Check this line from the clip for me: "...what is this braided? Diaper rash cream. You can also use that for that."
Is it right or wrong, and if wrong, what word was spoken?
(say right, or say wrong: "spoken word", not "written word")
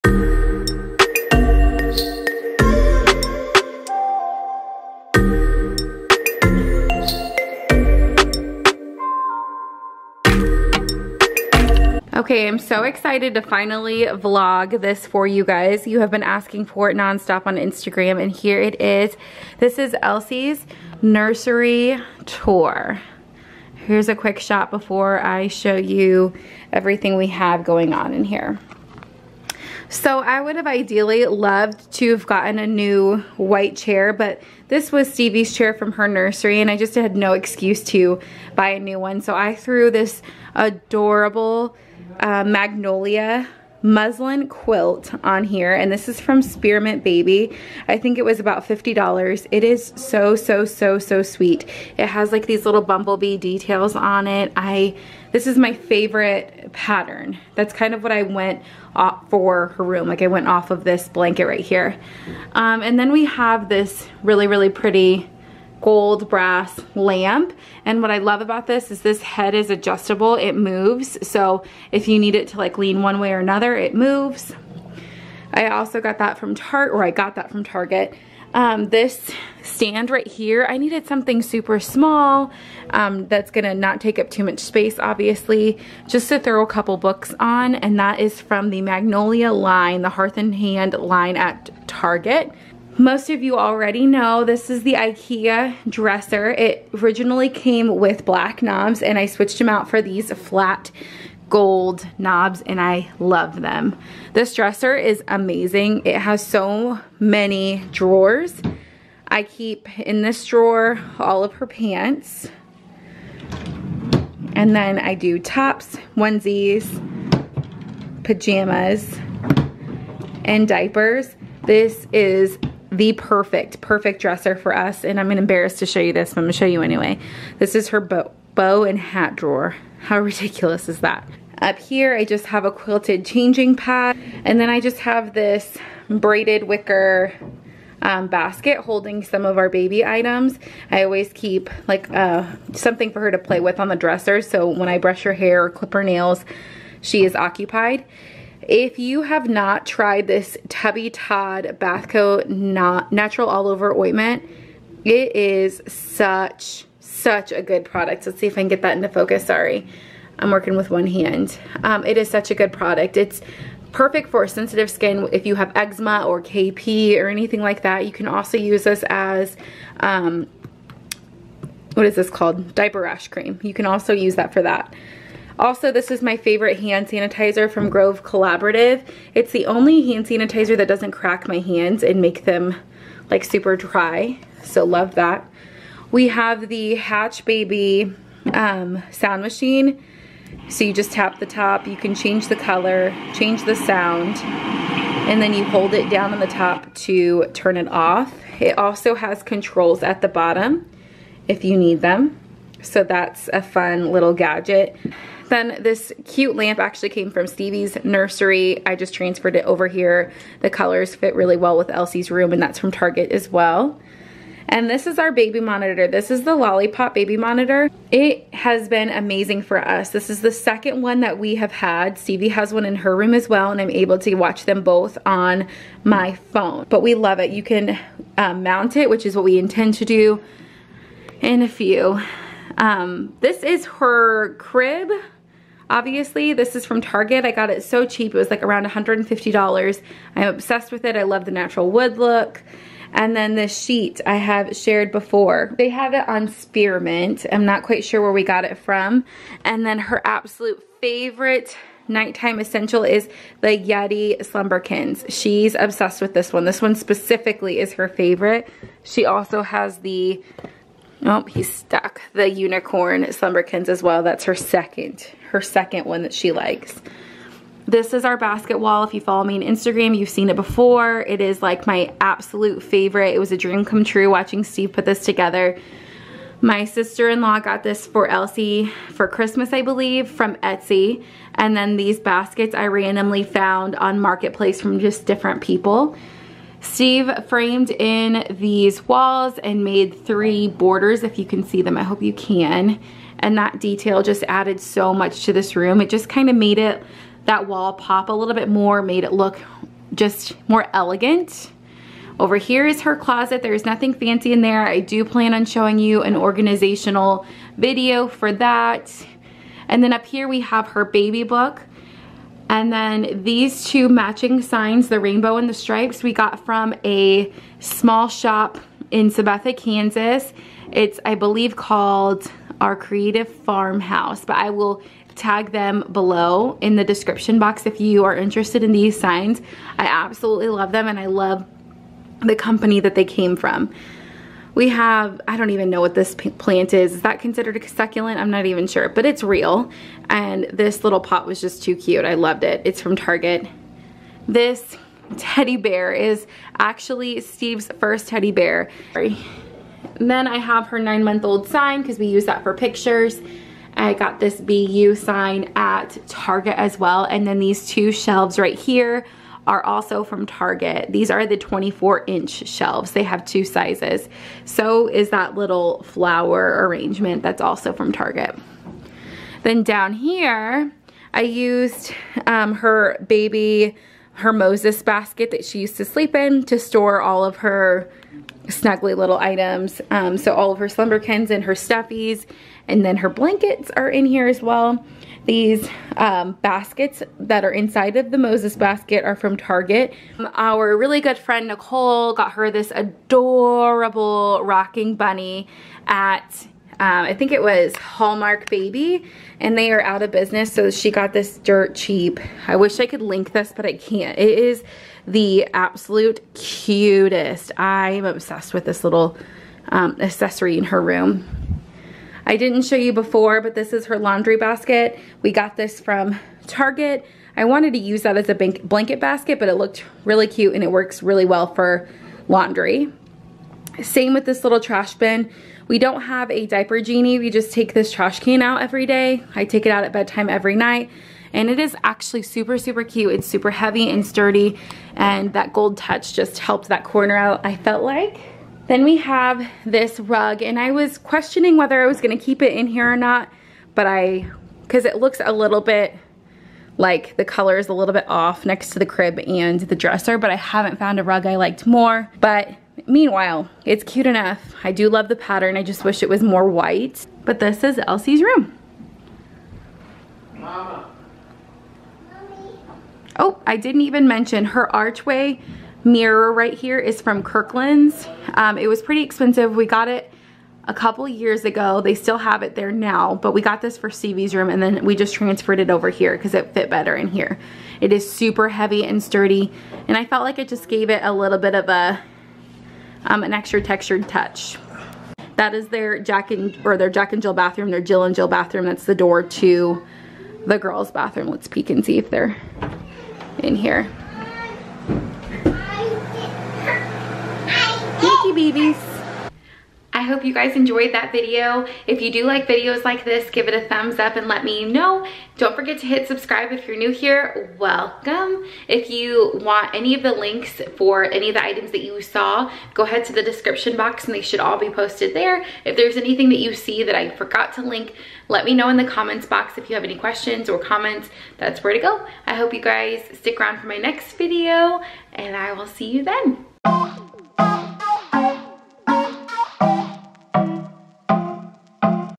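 wrong: "called", not "braided".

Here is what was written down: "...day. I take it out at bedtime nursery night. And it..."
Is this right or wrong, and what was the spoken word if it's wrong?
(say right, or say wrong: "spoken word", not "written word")
wrong: "every", not "nursery".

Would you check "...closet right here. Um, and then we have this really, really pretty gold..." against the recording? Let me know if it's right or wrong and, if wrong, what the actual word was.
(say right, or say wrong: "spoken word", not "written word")
wrong: "blanket", not "closet".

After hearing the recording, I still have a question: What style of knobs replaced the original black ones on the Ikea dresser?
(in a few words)
flat gold knobs.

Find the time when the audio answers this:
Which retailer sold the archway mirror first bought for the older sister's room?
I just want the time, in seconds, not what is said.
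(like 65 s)
467 s.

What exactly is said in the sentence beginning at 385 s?
These um, baskets that are inside of the Moses basket are from Target.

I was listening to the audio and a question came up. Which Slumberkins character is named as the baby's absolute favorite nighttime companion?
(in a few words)
Yeti.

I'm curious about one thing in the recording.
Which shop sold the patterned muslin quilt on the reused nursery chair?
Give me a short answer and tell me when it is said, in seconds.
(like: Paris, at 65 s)
Spearmint Baby, at 46 s.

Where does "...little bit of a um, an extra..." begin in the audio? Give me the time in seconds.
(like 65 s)
481 s.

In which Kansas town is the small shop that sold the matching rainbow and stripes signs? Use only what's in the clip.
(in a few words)
Sabetha.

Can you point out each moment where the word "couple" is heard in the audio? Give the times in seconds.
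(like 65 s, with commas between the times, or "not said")
86 s, 470 s.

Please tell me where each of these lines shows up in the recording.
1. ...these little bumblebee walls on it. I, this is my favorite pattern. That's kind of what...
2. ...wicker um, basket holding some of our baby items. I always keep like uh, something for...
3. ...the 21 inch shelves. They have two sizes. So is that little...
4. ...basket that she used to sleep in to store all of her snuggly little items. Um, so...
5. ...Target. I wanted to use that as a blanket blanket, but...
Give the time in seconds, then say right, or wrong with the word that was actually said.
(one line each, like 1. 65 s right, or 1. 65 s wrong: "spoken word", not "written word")
1. 52 s wrong: "details", not "walls"
2. 136 s right
3. 361 s wrong: "24", not "21"
4. 375 s right
5. 416 s wrong: "basket", not "blanket".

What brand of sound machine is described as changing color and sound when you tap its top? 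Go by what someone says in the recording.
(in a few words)
Hatch Baby.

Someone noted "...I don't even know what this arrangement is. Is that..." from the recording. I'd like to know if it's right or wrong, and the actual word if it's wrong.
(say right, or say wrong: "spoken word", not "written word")
wrong: "plant", not "arrangement".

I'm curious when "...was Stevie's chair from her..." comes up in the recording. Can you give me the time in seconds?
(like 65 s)
34 s.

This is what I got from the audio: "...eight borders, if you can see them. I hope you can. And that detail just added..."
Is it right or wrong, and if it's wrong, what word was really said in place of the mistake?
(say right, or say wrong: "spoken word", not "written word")
wrong: "three", not "eight".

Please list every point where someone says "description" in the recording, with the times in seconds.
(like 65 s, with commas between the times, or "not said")
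327 s, 513 s.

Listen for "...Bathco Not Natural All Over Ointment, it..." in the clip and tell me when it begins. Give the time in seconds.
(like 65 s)
151 s.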